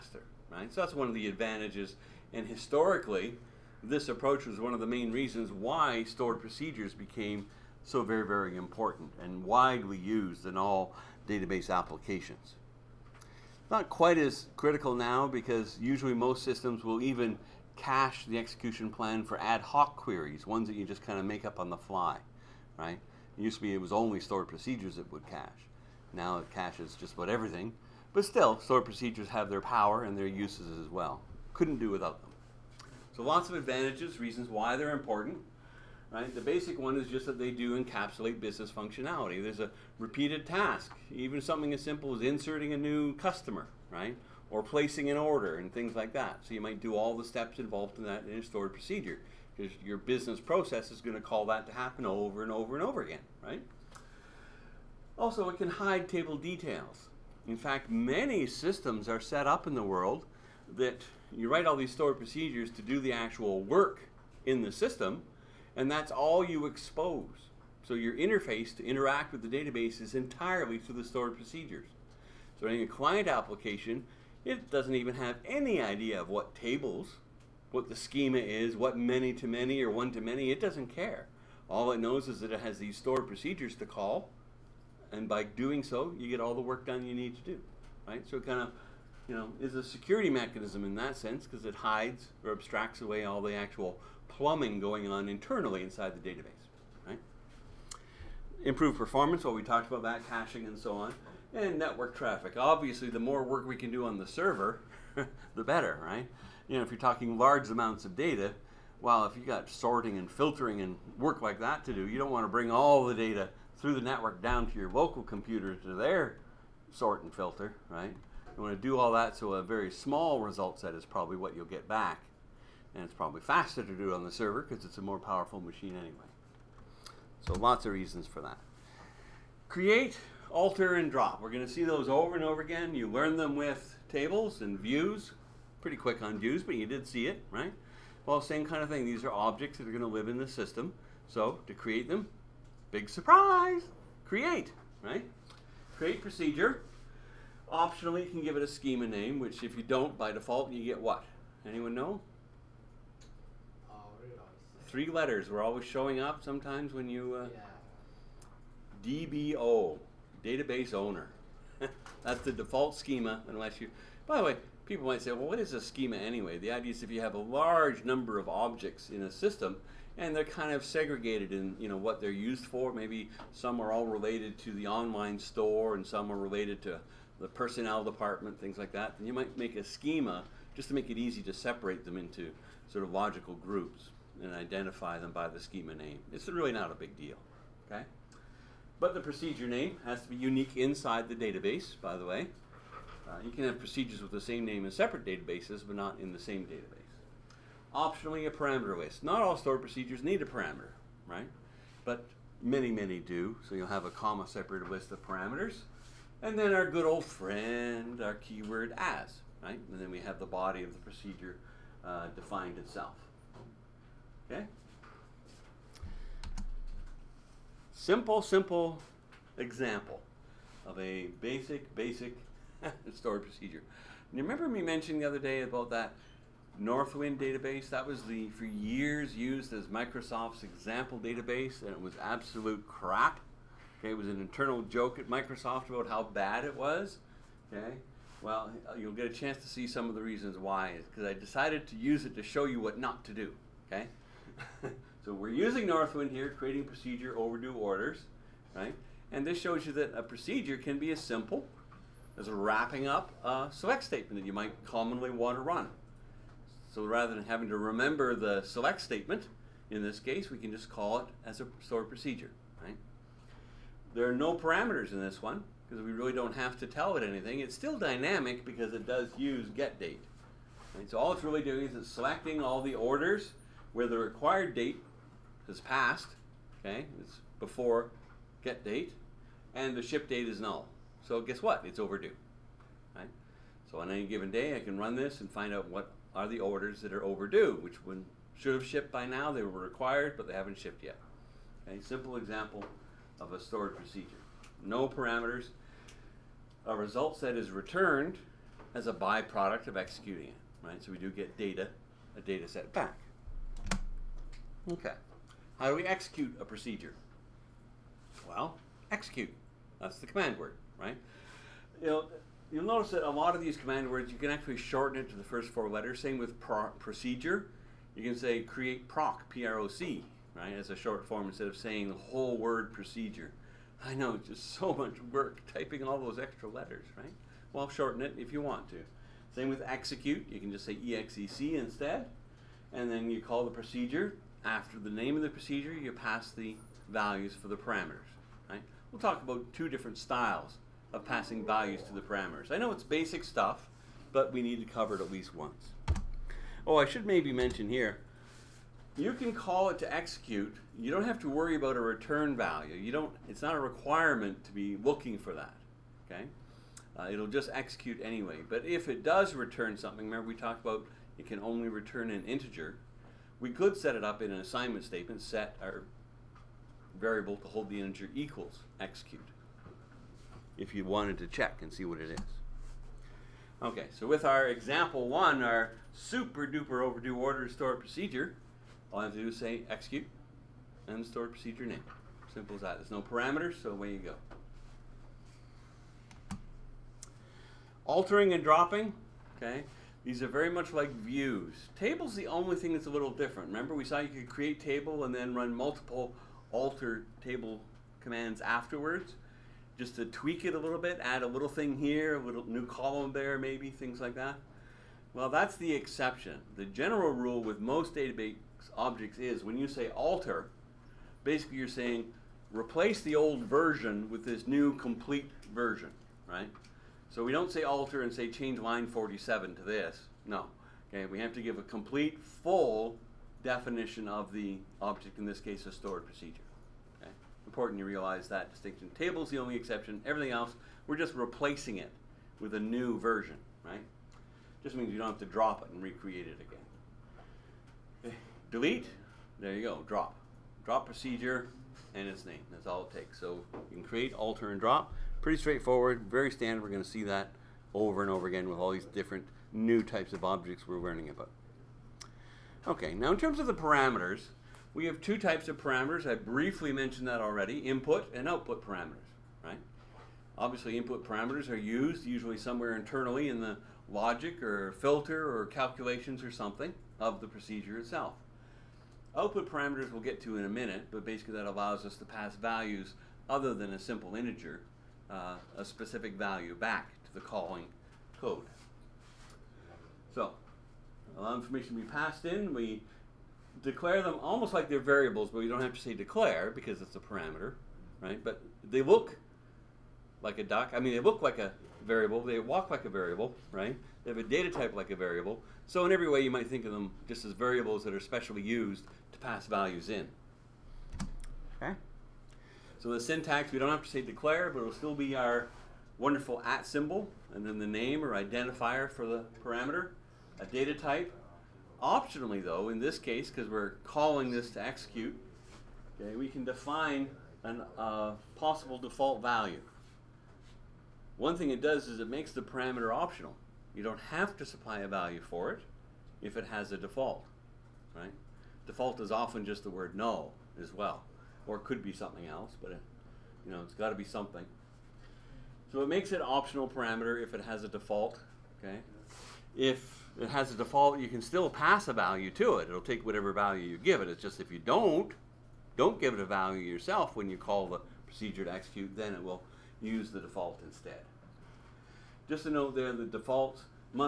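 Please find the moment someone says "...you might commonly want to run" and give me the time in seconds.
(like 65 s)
254 s.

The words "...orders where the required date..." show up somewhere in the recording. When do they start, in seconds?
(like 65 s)
272 s.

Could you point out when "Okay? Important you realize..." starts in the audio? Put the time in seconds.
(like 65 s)
427 s.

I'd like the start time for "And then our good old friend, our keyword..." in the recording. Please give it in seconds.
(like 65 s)
206 s.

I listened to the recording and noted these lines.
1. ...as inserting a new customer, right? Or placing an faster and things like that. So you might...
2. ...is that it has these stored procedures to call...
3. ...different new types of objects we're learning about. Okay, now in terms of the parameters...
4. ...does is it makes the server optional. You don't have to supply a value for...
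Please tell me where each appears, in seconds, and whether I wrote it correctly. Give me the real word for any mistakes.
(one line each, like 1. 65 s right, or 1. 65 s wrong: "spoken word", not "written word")
1. 42 s wrong: "order", not "faster"
2. 82 s right
3. 449 s right
4. 521 s wrong: "parameter", not "server".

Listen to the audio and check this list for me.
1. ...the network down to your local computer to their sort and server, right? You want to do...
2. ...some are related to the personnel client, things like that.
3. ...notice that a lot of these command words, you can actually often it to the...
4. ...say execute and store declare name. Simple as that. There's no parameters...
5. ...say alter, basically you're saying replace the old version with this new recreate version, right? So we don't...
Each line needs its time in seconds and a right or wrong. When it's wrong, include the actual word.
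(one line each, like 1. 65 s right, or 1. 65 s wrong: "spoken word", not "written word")
1. 113 s wrong: "filter", not "server"
2. 176 s wrong: "department", not "client"
3. 312 s wrong: "shorten", not "often"
4. 379 s wrong: "procedure", not "declare"
5. 409 s wrong: "complete", not "recreate".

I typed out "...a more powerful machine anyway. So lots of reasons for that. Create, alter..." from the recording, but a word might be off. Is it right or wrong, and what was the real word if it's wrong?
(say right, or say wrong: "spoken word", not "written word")
right.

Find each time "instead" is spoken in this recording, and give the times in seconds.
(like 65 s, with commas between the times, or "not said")
321 s, 331 s, 550 s.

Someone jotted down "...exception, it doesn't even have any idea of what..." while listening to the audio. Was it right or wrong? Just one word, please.
wrong.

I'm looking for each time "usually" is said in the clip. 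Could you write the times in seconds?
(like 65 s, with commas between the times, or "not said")
15 s, 462 s.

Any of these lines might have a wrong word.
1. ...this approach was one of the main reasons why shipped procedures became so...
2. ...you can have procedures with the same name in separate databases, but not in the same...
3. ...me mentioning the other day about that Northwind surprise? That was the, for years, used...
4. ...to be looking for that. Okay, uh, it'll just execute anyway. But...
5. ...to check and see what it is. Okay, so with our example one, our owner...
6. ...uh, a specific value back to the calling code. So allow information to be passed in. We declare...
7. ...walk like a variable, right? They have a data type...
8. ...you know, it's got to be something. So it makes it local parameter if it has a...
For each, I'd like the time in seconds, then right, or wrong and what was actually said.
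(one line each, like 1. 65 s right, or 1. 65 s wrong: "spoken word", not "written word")
1. 3 s wrong: "stored", not "shipped"
2. 193 s right
3. 224 s wrong: "database", not "surprise"
4. 354 s right
5. 371 s wrong: "super", not "owner"
6. 475 s right
7. 492 s right
8. 533 s wrong: "optional", not "local".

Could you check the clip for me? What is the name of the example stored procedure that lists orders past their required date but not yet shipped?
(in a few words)
overdue orders.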